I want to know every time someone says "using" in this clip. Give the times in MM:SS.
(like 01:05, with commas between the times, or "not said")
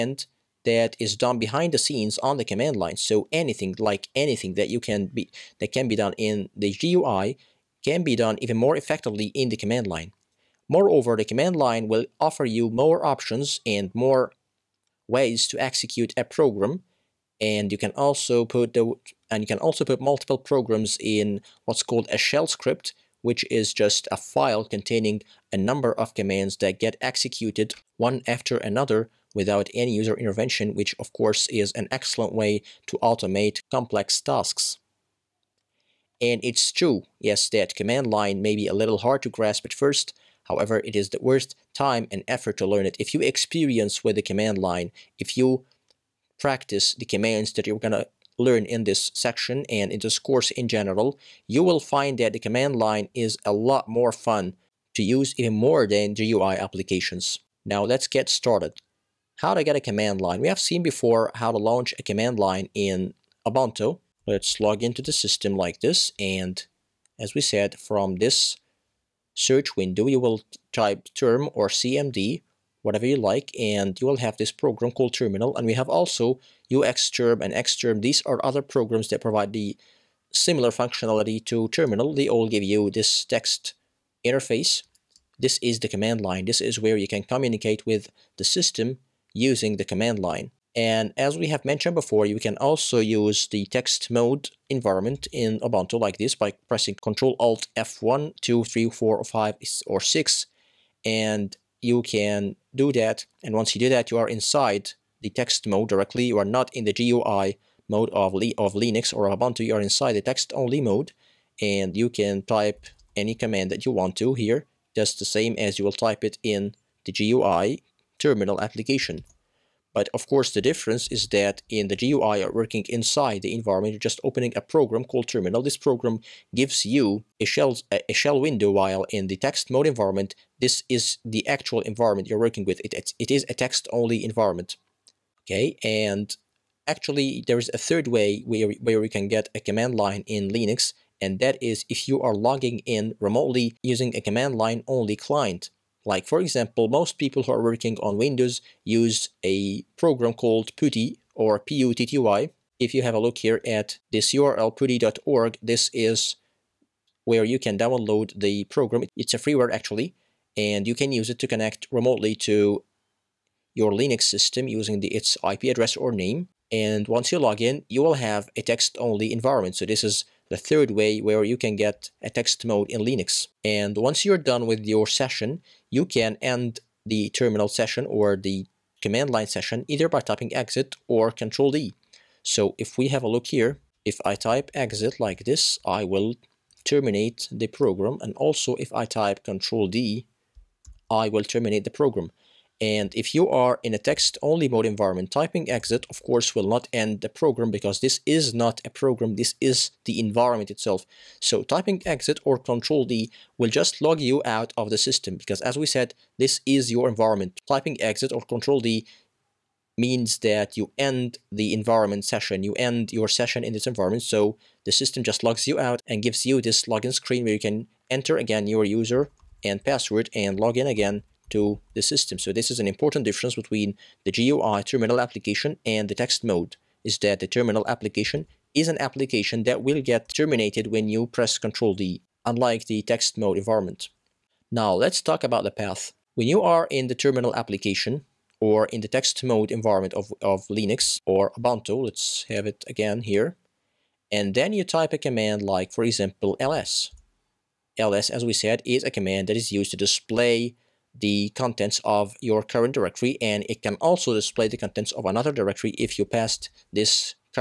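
01:29, 02:23, 02:44.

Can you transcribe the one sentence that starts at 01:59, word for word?
But of course, the difference is that in the GUI or working inside the environment, you're just opening a program called terminal.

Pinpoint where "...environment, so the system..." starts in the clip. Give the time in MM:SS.
03:33.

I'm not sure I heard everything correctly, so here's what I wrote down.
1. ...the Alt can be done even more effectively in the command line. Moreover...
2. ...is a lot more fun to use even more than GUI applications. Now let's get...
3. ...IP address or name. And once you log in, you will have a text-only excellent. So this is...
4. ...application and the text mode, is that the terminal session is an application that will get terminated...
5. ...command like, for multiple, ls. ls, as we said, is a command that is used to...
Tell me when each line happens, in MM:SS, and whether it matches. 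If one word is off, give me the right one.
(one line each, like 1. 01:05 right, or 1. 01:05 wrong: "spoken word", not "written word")
1. 00:06 wrong: "GUI", not "Alt"
2. 00:53 right
3. 02:45 wrong: "environment", not "excellent"
4. 03:45 wrong: "application", not "session"
5. 04:05 wrong: "example", not "multiple".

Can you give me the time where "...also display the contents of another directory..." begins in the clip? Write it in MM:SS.
04:13.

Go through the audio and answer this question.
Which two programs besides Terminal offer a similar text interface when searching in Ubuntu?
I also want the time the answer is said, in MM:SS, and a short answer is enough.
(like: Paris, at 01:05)
UXterm and Xterm, at 01:16.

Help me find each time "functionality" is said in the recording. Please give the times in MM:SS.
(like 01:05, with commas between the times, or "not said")
01:20.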